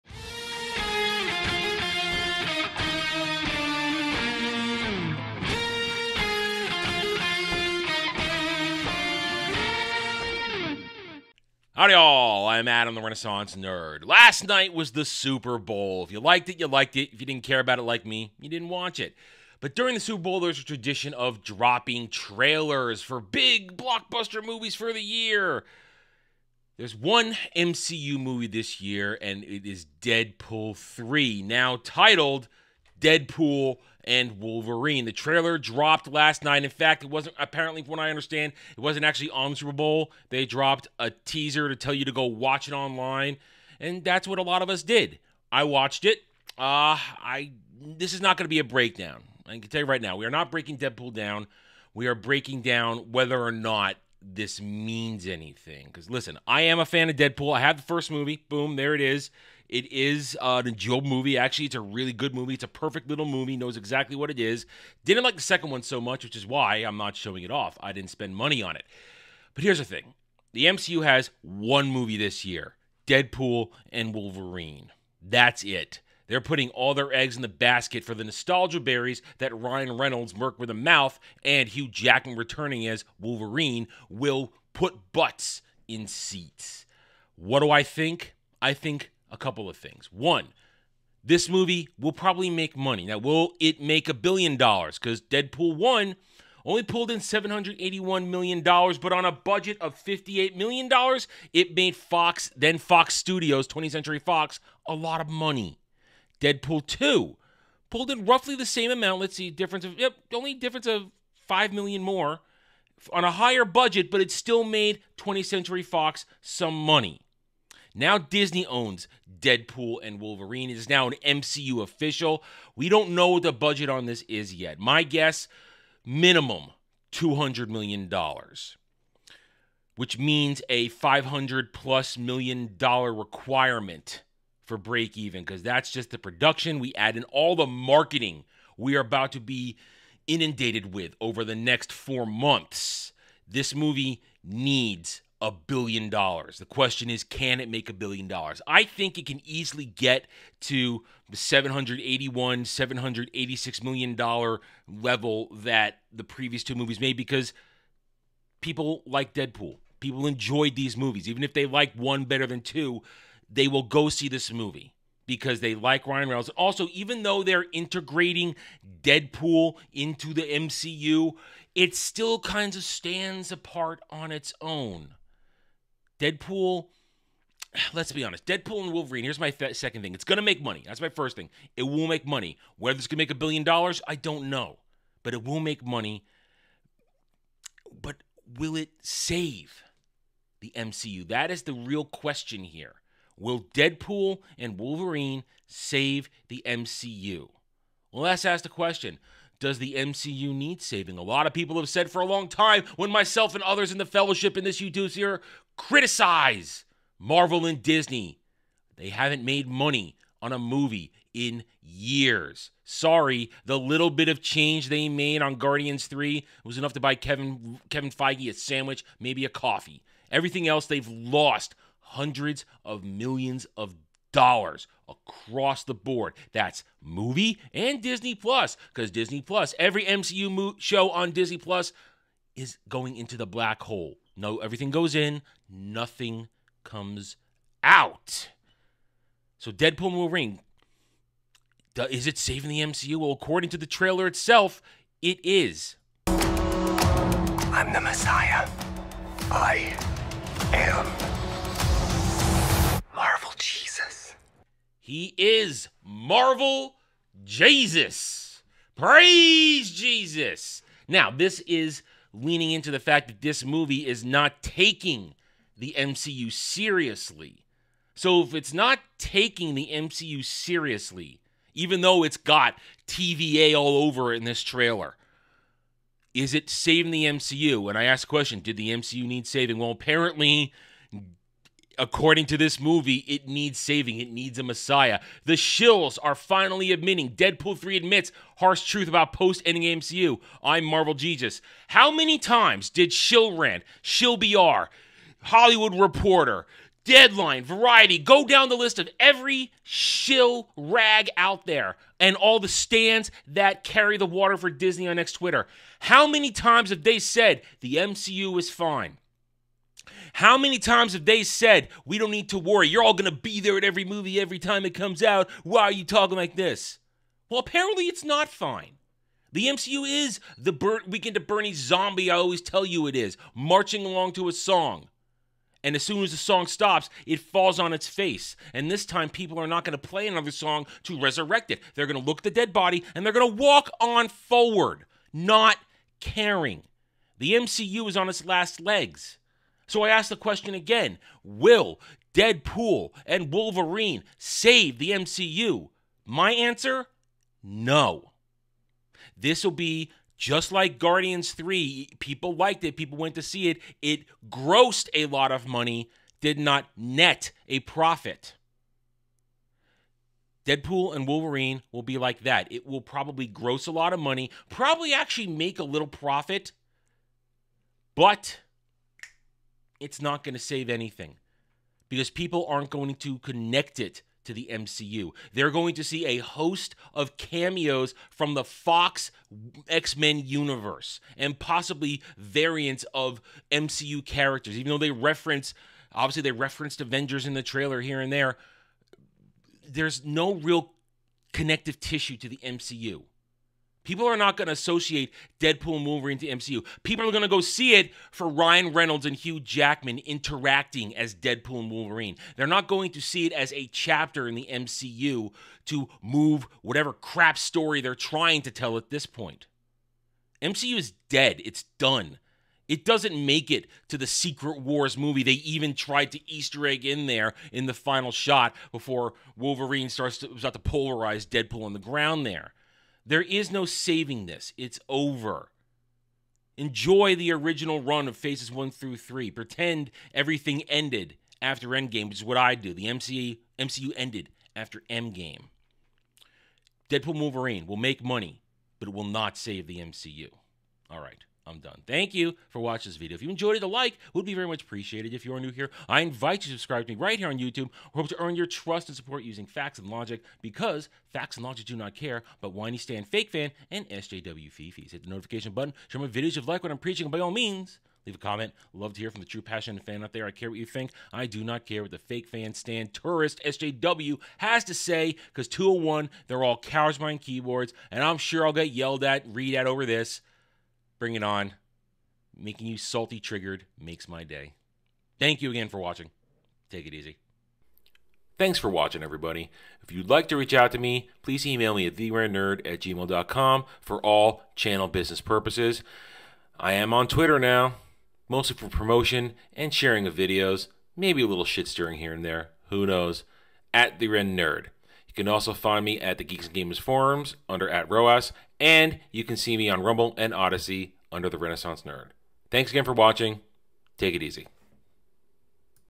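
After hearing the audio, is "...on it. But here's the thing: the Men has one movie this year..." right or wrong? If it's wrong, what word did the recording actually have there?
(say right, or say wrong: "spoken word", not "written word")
wrong: "MCU", not "Men".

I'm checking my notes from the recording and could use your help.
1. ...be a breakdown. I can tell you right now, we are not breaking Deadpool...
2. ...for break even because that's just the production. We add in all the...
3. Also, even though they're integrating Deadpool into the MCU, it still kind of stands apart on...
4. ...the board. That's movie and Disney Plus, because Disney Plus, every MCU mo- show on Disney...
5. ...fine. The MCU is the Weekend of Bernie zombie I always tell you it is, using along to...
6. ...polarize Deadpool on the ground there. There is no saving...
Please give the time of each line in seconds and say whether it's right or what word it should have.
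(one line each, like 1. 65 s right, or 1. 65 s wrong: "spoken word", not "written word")
1. 48 s right
2. 134 s right
3. 166 s right
4. 225 s right
5. 318 s wrong: "marching", not "using"
6. 420 s right.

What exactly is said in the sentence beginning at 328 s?
And this time, people are not going to play another song to resurrect it.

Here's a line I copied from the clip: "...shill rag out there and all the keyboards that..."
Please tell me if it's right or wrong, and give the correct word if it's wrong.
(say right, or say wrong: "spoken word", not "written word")
wrong: "stands", not "keyboards".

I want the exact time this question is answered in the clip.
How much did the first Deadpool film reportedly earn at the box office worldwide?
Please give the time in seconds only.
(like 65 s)
97 s.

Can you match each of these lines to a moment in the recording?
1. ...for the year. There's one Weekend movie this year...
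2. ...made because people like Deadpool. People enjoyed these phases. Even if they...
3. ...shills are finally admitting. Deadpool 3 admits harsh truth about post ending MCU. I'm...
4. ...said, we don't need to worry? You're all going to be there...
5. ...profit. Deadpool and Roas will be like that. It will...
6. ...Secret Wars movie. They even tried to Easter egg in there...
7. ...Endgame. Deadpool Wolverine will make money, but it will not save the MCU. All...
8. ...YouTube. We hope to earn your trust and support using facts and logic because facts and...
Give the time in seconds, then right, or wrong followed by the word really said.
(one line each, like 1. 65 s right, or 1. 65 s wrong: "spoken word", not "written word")
1. 24 s wrong: "MCU", not "Weekend"
2. 156 s wrong: "movies", not "phases"
3. 285 s right
4. 311 s right
5. 357 s wrong: "Wolverine", not "Roas"
6. 414 s right
7. 435 s right
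8. 447 s right.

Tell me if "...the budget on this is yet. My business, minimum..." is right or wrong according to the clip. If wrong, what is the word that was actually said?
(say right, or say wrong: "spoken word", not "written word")
wrong: "guess", not "business".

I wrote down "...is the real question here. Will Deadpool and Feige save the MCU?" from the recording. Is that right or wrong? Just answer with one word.
wrong.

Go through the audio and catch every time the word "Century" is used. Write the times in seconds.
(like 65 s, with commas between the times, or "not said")
103 s, 115 s.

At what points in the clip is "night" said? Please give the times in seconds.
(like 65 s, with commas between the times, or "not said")
14 s, 36 s.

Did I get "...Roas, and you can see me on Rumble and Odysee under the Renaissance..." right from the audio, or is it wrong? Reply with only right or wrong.
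right.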